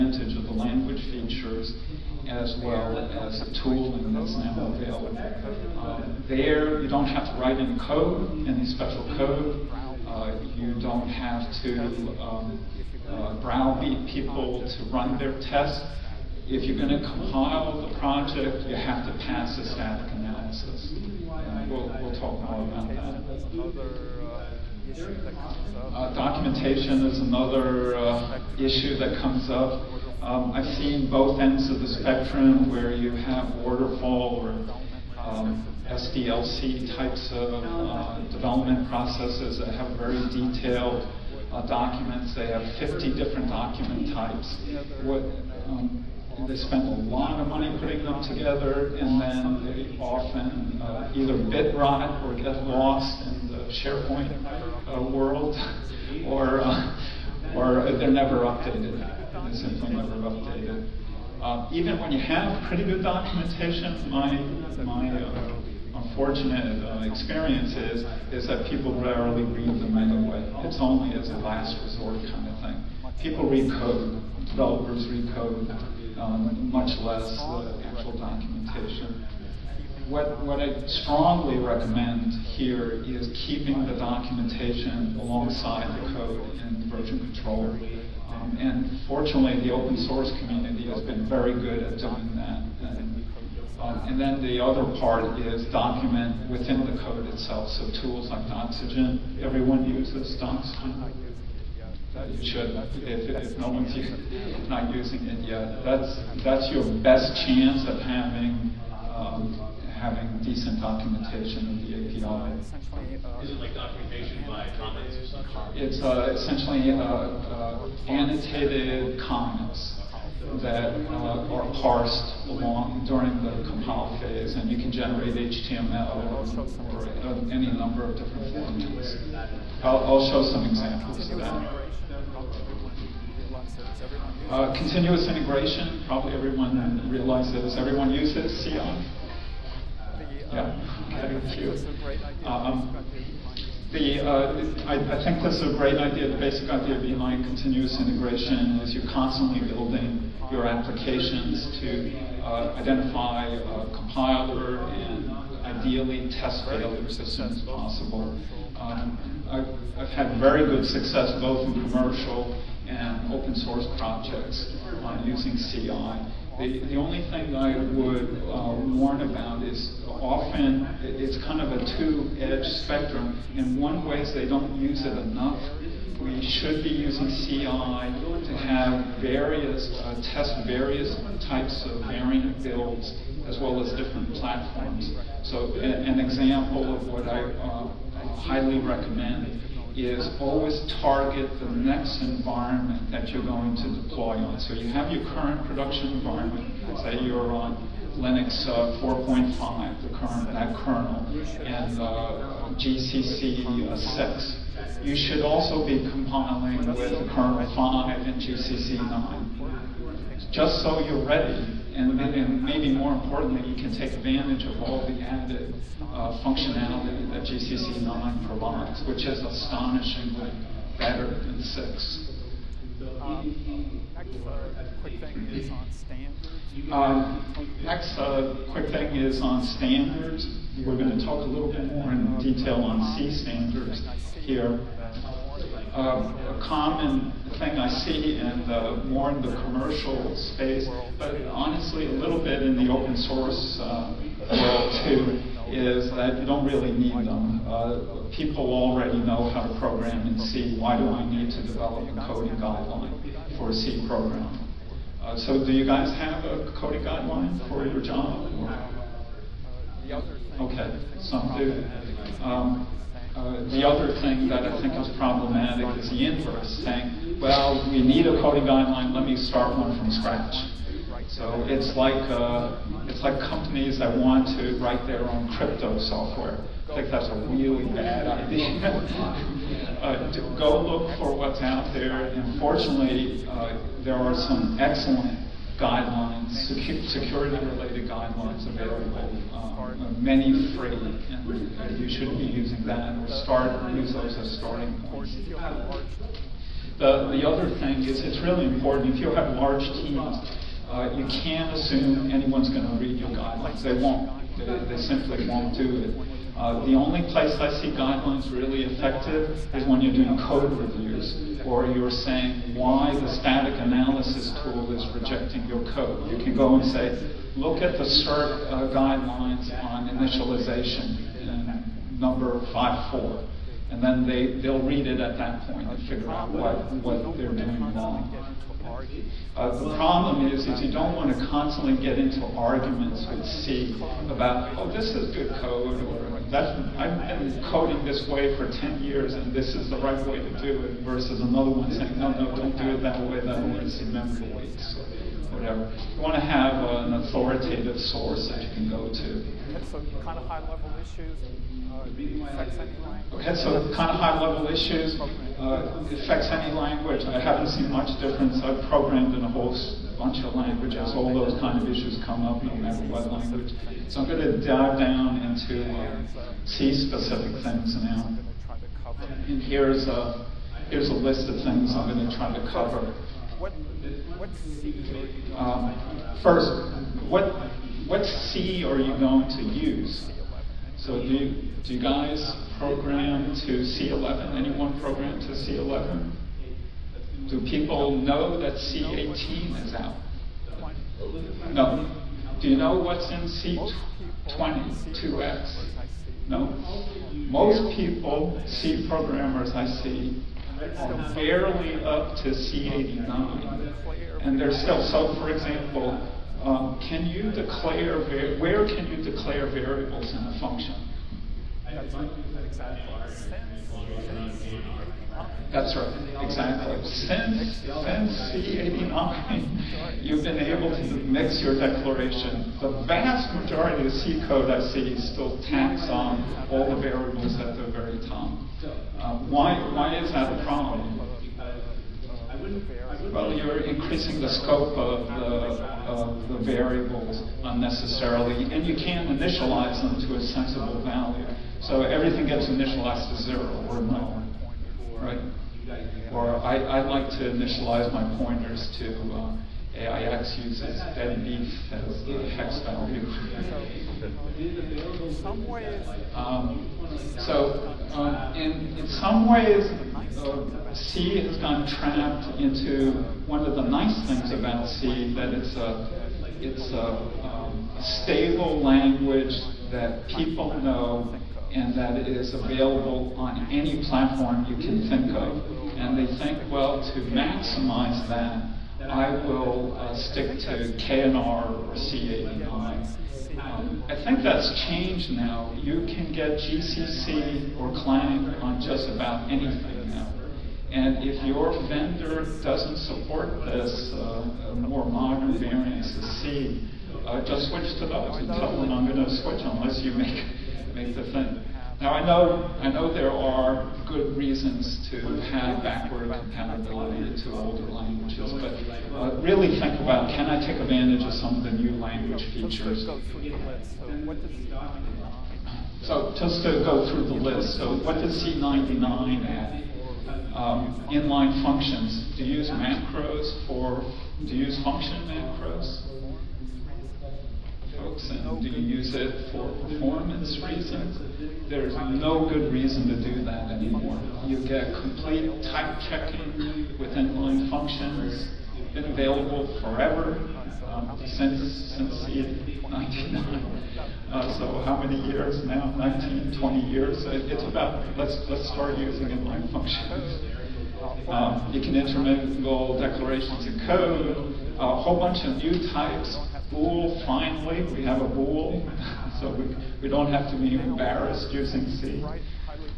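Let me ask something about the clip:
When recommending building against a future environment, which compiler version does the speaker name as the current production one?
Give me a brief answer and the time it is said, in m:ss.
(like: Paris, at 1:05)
GCC 6, at 3:22.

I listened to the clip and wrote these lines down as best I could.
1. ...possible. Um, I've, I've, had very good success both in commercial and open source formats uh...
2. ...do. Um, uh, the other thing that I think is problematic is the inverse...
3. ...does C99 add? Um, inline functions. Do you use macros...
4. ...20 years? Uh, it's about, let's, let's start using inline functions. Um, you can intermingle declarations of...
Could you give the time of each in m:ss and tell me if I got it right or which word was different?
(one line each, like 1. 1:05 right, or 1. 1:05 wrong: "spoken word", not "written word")
1. 2:37 wrong: "projects", not "formats"
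2. 4:21 right
3. 8:38 right
4. 9:06 right.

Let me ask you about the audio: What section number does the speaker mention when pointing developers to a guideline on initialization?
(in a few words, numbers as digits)
5.4.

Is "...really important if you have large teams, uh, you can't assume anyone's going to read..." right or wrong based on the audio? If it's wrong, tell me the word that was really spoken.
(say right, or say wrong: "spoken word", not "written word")
right.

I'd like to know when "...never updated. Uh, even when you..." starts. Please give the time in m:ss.
0:59.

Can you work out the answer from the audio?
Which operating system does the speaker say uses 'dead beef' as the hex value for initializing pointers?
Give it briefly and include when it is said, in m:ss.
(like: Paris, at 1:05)
AIX, at 7:29.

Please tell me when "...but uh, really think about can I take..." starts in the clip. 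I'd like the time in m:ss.
8:28.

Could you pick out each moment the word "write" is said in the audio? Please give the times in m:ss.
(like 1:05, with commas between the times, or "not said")
0:07, 4:34.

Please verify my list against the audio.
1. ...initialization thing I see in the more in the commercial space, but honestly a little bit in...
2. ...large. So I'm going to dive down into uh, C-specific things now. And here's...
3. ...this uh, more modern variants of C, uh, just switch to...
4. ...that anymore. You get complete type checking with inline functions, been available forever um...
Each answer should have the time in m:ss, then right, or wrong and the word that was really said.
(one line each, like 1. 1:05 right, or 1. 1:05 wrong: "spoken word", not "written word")
1. 3:56 wrong: "common", not "initialization"
2. 6:03 wrong: "language", not "large"
3. 8:13 right
4. 8:53 right.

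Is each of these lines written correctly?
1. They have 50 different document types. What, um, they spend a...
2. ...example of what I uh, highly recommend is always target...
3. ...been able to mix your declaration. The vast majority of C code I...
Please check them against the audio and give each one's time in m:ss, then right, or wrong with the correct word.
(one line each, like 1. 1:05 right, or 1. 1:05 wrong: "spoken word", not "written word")
1. 0:42 right
2. 3:06 right
3. 7:00 right.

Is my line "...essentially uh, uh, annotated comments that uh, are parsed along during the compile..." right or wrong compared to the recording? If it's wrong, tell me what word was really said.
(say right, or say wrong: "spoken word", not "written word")
right.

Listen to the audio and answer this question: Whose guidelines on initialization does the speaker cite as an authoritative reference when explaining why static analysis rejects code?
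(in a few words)
CERT.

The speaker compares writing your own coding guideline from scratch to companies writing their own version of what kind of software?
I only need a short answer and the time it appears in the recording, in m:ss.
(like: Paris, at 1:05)
crypto software, at 4:35.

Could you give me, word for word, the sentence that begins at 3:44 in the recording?
next quick thing is on standards.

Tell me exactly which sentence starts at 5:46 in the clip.
You want to have an authoritative source that you can go to.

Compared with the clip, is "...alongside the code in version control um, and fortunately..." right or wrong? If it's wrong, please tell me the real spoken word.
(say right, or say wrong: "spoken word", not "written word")
right.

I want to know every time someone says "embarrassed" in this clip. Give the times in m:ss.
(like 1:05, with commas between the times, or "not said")
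9:20.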